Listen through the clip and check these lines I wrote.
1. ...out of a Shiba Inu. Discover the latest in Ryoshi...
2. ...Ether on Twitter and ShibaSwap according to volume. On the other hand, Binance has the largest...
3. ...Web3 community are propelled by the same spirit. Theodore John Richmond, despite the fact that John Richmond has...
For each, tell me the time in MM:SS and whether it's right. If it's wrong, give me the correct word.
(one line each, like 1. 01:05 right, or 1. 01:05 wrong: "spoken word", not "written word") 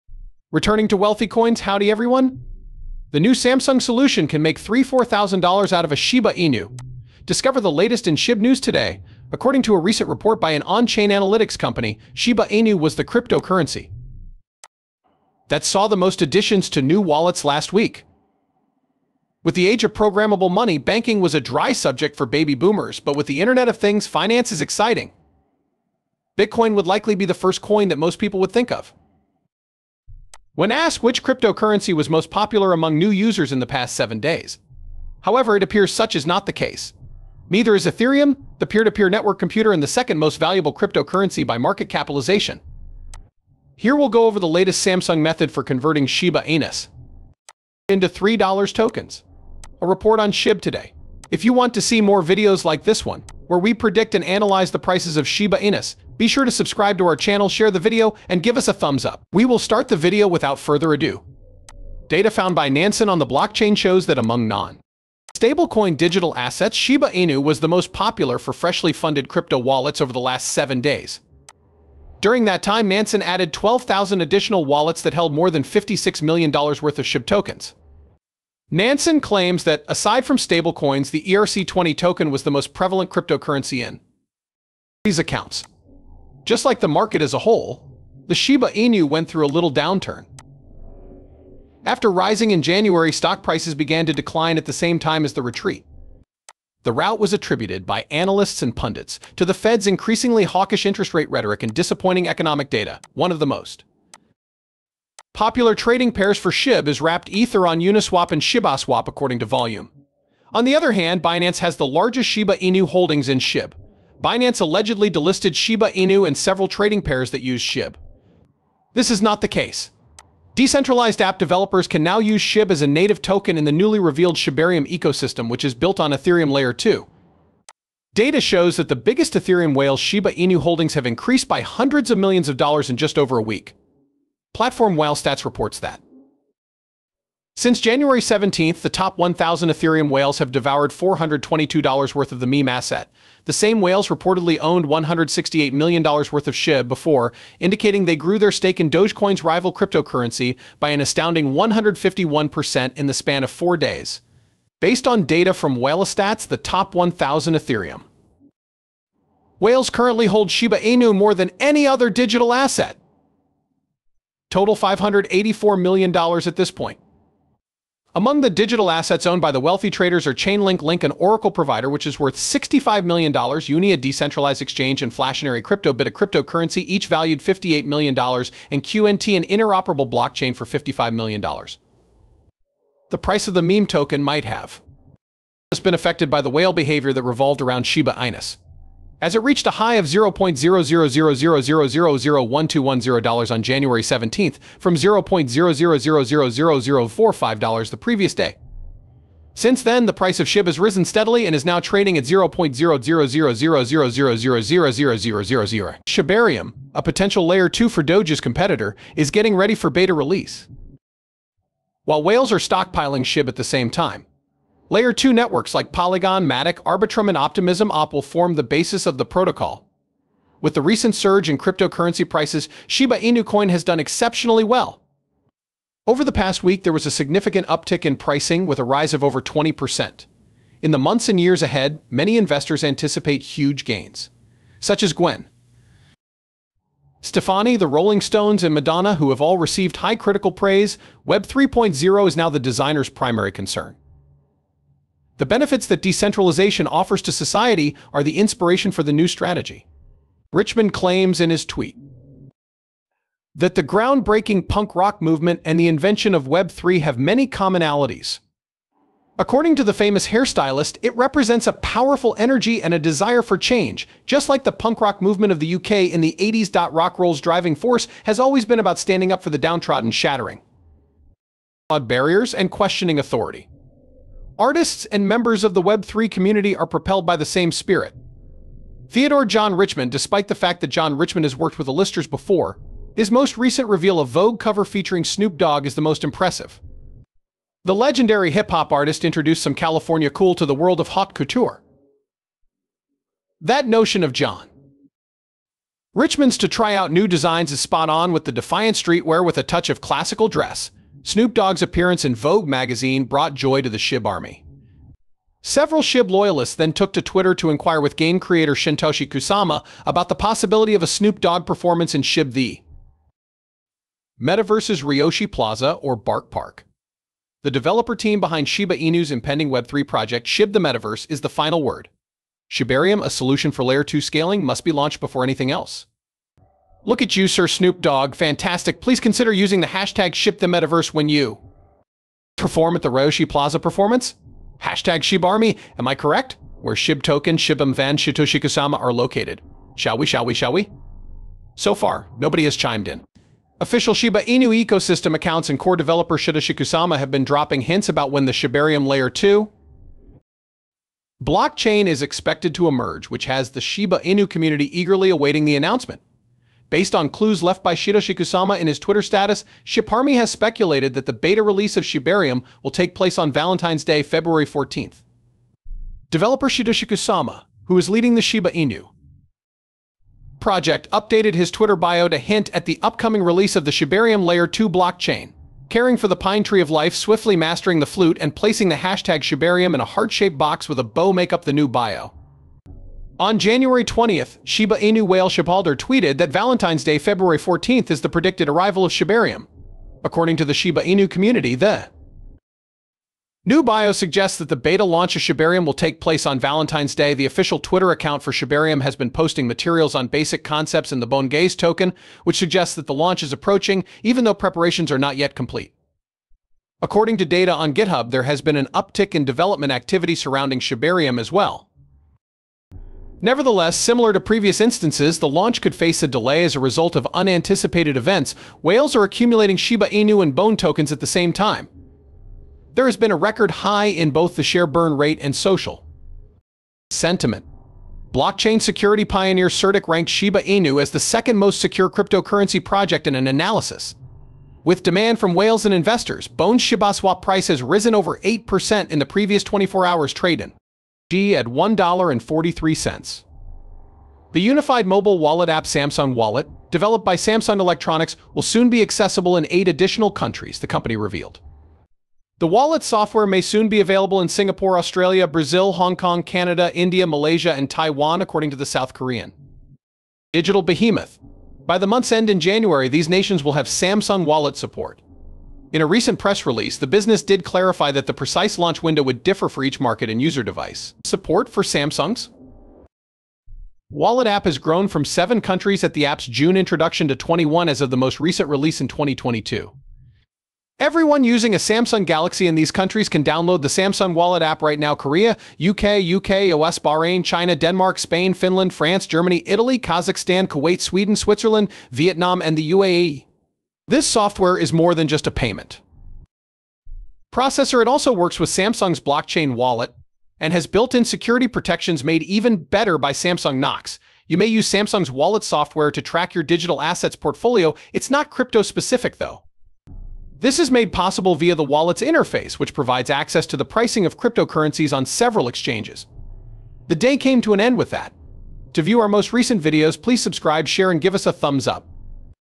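1. 00:05 wrong: "SHIB", not "Ryoshi"
2. 01:47 wrong: "Uniswap", not "Twitter"
3. 04:35 right.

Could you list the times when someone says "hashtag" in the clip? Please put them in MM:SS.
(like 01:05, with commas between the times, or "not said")
05:29, 05:34, 06:18.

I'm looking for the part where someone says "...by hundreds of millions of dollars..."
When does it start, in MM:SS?
02:11.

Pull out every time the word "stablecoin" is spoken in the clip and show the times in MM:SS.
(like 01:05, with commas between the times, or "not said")
01:05, 01:20.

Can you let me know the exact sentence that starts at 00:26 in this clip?
Bitcoin would likely be the first coin that most people would think of.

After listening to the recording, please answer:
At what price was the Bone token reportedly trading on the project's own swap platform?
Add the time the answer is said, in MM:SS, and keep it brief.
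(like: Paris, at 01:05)
$1.43, at 07:21.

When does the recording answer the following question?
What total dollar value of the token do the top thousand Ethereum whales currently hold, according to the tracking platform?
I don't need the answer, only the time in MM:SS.
02:44.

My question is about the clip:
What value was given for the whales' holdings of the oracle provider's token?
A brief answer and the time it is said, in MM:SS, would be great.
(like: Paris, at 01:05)
$65 million, at 02:52.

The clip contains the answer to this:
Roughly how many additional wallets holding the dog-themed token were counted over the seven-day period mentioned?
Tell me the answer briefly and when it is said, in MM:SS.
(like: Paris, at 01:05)
12,000, at 01:13.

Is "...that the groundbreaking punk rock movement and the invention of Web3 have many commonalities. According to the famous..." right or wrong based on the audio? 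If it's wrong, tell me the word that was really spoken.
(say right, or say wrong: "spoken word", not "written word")
right.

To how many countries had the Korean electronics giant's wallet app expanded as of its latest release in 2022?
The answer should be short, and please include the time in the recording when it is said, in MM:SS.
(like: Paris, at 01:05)
21, at 07:57.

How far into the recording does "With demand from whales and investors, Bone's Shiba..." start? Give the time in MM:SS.
07:14.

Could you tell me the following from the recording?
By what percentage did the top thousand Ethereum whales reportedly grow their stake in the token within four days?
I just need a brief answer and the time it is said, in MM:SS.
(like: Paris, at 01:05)
151%, at 02:31.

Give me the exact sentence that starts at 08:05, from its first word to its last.
Korea, UK, UK, US, Bahrain, China, Denmark, Spain, Finland, France, Germany, Italy, Kazakhstan, Kuwait, Sweden, Switzerland, Vietnam, and the UAE.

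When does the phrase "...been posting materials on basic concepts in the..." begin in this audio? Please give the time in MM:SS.
06:39.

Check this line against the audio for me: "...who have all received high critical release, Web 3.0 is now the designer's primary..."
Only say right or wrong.
wrong.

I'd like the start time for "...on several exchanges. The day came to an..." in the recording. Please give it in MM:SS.
08:35.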